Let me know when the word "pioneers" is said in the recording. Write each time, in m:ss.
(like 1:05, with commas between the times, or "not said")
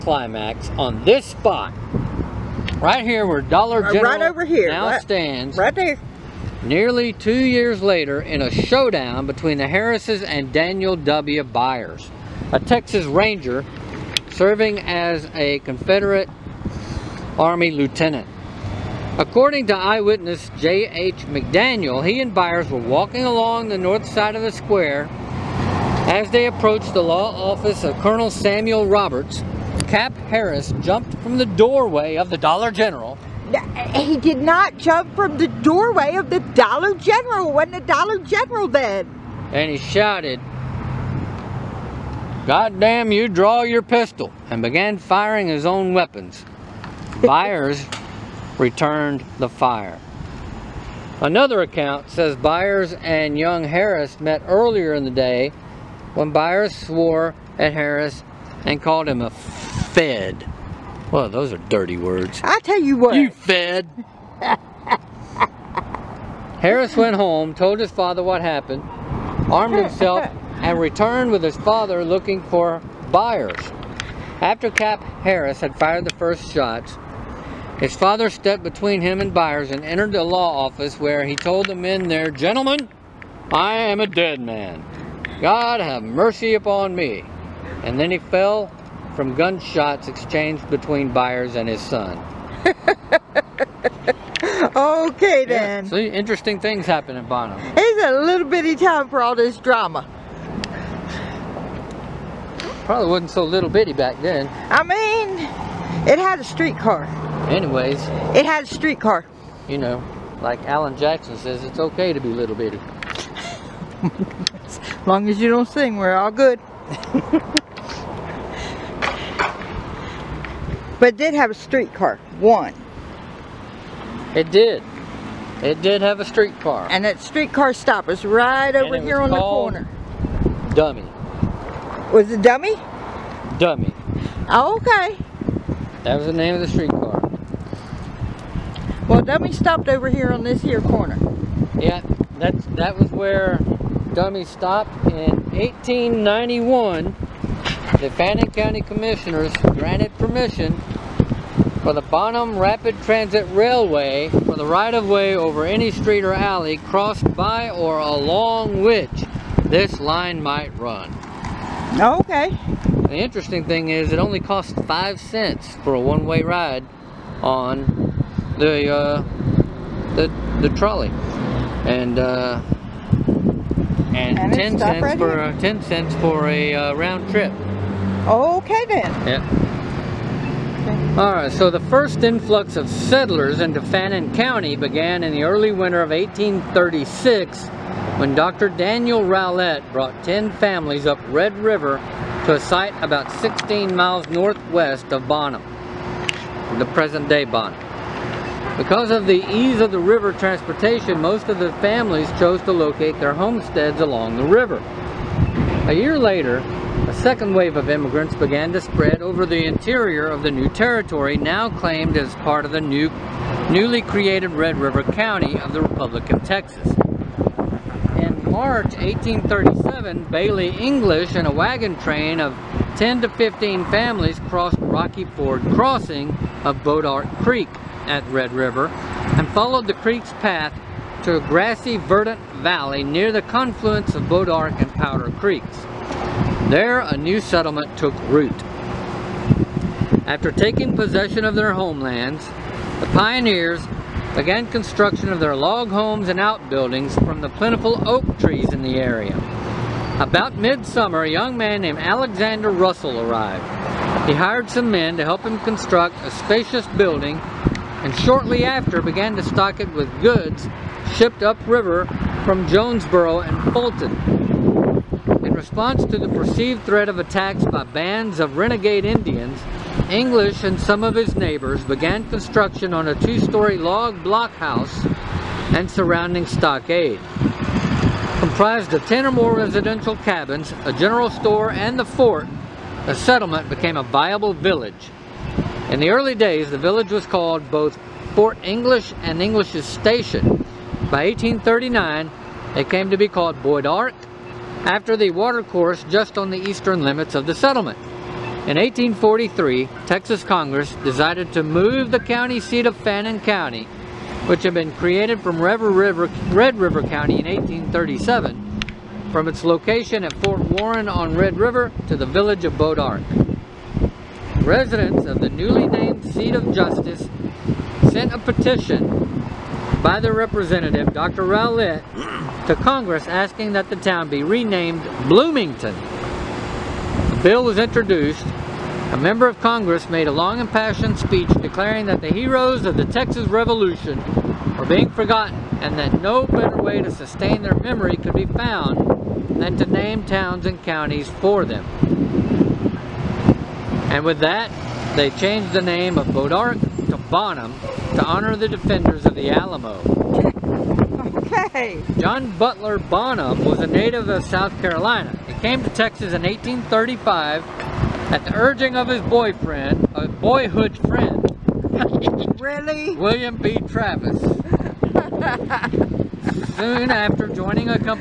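4:03.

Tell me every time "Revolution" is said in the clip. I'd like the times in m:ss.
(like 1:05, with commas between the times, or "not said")
5:33.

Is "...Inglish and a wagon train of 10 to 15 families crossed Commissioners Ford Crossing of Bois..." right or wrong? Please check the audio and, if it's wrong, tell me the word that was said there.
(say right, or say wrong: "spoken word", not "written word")
wrong: "Rocky", not "Commissioners".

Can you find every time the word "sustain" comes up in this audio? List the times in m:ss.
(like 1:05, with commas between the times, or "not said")
5:37.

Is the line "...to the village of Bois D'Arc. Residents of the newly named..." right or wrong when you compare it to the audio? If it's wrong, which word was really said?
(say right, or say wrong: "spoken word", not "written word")
right.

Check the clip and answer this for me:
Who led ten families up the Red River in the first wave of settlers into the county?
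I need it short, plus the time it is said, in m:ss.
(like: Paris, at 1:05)
Dr. Daniel Rowlett, at 3:08.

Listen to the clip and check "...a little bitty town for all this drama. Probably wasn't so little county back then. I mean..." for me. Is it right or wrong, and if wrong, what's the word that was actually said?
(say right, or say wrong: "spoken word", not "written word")
wrong: "bitty", not "county".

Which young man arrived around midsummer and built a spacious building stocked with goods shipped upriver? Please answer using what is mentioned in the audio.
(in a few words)
Alexander Russell.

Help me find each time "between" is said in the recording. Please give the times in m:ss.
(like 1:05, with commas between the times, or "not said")
0:09, 1:18, 1:30.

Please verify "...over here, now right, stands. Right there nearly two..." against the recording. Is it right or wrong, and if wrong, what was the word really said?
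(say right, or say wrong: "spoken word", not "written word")
right.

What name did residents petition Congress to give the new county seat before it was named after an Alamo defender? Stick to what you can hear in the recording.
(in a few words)
Bloomington.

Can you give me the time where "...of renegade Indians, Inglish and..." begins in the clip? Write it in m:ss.
4:28.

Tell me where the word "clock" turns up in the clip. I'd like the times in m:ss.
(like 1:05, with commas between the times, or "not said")
not said.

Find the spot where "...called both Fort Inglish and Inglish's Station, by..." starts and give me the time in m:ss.
4:47.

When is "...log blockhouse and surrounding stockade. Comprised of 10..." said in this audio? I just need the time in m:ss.
4:33.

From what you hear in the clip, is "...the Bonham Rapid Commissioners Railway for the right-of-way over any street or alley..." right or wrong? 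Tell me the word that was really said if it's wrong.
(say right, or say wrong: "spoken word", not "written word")
wrong: "Transit", not "Commissioners".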